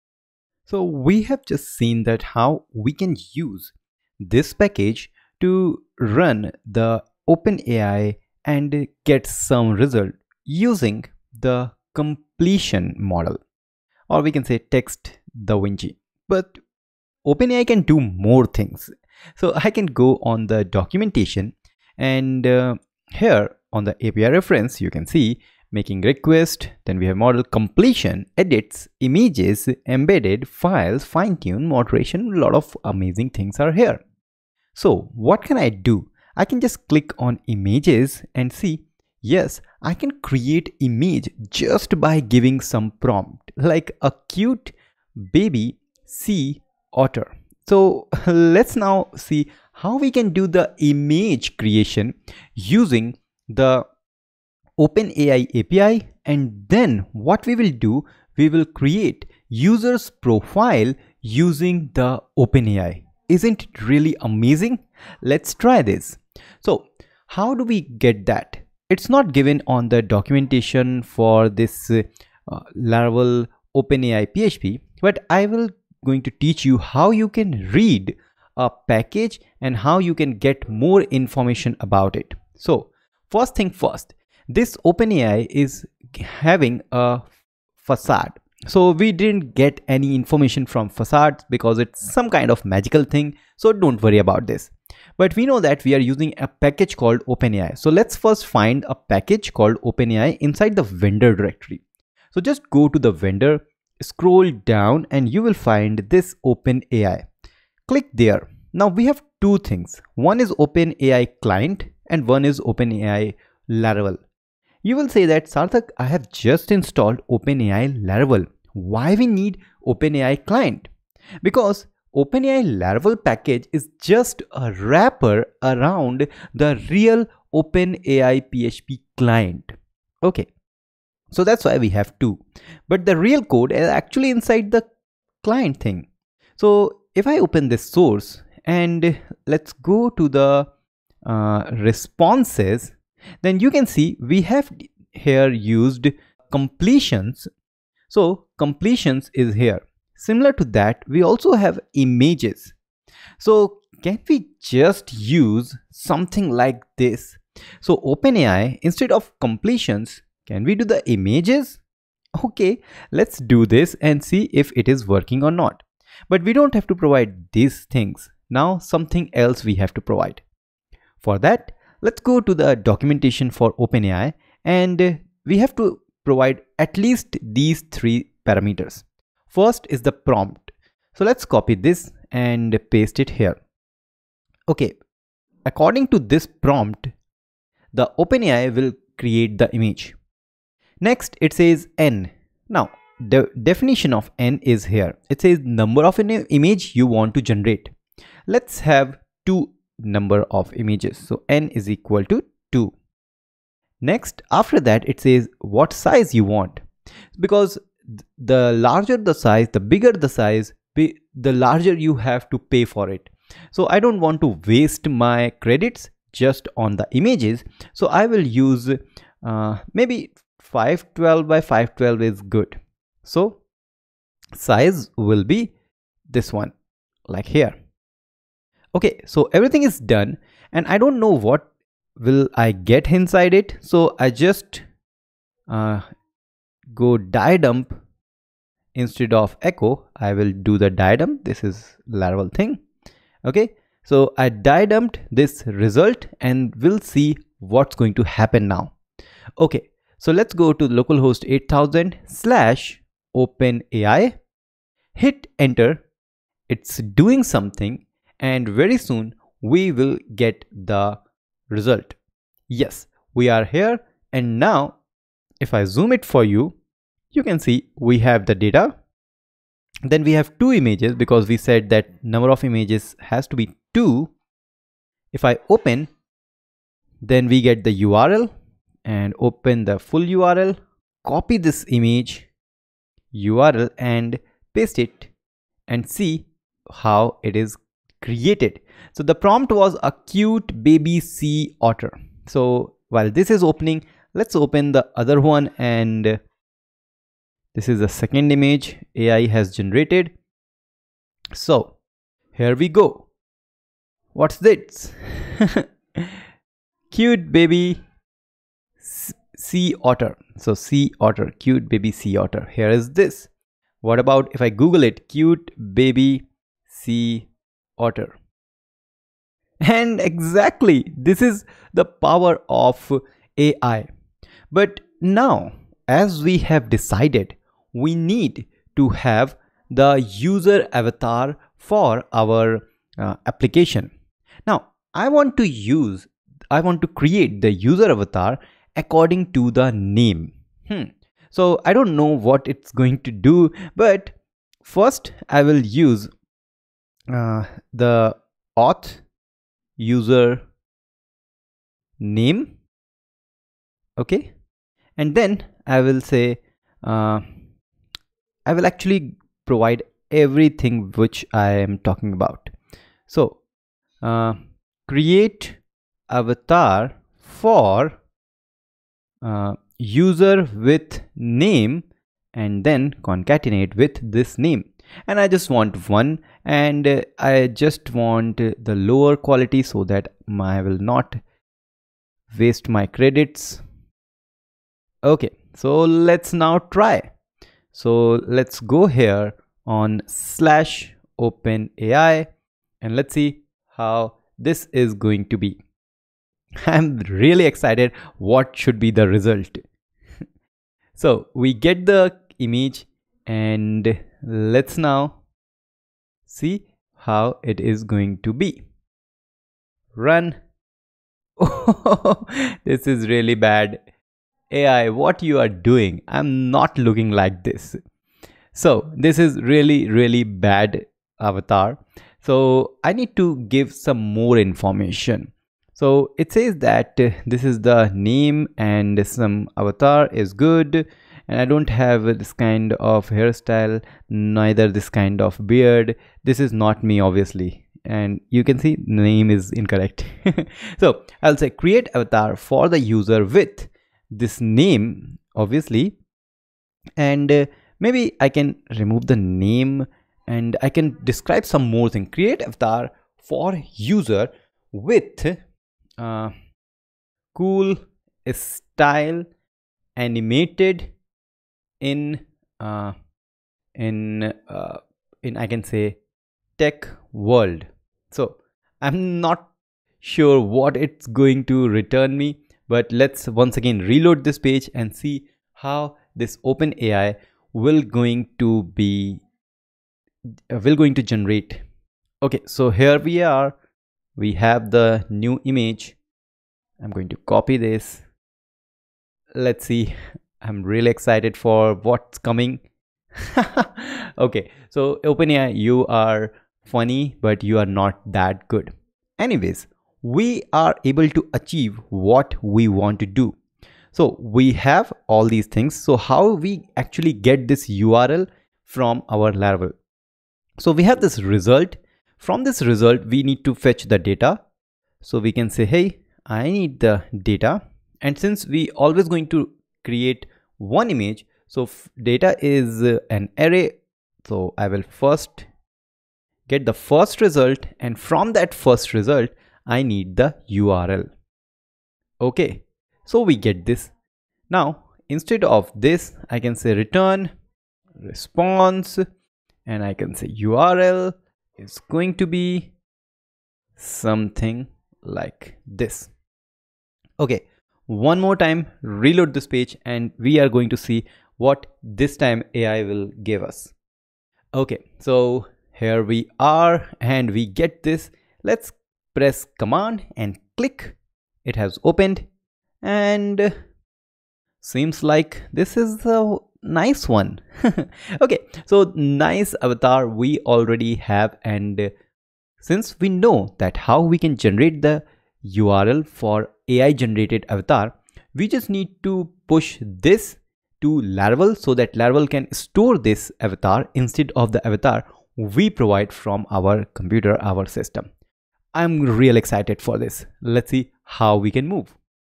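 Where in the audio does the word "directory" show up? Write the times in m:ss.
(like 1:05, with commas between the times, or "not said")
1:41.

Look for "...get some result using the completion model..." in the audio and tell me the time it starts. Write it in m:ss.
0:09.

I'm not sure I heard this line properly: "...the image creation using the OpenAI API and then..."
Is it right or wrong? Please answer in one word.
right.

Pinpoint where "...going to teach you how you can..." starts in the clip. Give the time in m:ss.
1:16.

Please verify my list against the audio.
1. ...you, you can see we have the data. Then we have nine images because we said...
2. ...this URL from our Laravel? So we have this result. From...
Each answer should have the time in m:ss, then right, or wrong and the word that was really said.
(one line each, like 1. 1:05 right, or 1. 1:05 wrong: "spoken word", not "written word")
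1. 4:26 wrong: "two", not "nine"
2. 8:27 right.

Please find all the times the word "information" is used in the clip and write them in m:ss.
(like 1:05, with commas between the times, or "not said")
1:21, 1:30, 7:04.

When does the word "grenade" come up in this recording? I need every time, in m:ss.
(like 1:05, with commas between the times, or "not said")
not said.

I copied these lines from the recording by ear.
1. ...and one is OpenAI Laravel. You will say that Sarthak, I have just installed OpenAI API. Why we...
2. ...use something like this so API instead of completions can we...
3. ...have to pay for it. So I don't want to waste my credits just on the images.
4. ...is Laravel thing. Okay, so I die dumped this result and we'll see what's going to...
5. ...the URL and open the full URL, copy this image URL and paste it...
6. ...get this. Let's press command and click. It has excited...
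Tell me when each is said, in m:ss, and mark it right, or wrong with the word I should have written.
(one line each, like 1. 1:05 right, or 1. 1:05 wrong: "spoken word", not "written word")
1. 1:52 wrong: "Laravel", not "API"
2. 2:35 wrong: "OpenAI", not "API"
3. 3:32 right
4. 4:01 right
5. 4:37 right
6. 9:17 wrong: "opened", not "excited".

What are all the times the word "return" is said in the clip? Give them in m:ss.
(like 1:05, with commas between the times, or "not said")
7:51, 8:56.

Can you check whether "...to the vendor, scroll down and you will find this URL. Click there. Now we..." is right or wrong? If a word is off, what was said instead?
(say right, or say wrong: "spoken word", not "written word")
wrong: "OpenAI", not "URL".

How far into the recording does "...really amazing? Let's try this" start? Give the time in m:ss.
1:03.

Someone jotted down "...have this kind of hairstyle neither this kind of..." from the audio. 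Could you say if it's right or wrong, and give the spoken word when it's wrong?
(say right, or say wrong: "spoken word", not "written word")
right.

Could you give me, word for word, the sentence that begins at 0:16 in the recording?
But OpenAI can do more things.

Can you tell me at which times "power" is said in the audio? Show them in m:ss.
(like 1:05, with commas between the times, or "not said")
5:22.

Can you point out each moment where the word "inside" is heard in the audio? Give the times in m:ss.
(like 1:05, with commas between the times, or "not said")
1:40, 2:14, 3:53.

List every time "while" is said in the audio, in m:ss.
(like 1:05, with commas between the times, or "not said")
4:53.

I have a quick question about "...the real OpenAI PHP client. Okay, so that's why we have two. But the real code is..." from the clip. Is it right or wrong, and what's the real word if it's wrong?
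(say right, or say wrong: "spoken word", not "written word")
right.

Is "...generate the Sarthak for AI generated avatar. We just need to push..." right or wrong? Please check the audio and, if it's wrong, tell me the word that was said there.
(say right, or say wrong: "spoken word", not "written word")
wrong: "URL", not "Sarthak".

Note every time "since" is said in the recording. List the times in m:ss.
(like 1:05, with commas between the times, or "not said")
8:38, 9:32.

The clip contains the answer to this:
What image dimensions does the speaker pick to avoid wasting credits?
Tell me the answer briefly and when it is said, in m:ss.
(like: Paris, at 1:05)
512 by 512, at 3:40.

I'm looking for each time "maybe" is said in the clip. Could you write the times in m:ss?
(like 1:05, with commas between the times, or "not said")
3:39, 7:27.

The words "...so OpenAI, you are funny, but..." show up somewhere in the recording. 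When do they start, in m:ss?
8:14.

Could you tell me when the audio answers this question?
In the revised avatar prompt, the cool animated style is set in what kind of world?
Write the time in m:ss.
7:46.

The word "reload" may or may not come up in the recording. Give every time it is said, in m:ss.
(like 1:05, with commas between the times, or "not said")
7:53, 9:09.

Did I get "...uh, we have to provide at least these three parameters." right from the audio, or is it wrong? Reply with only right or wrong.
right.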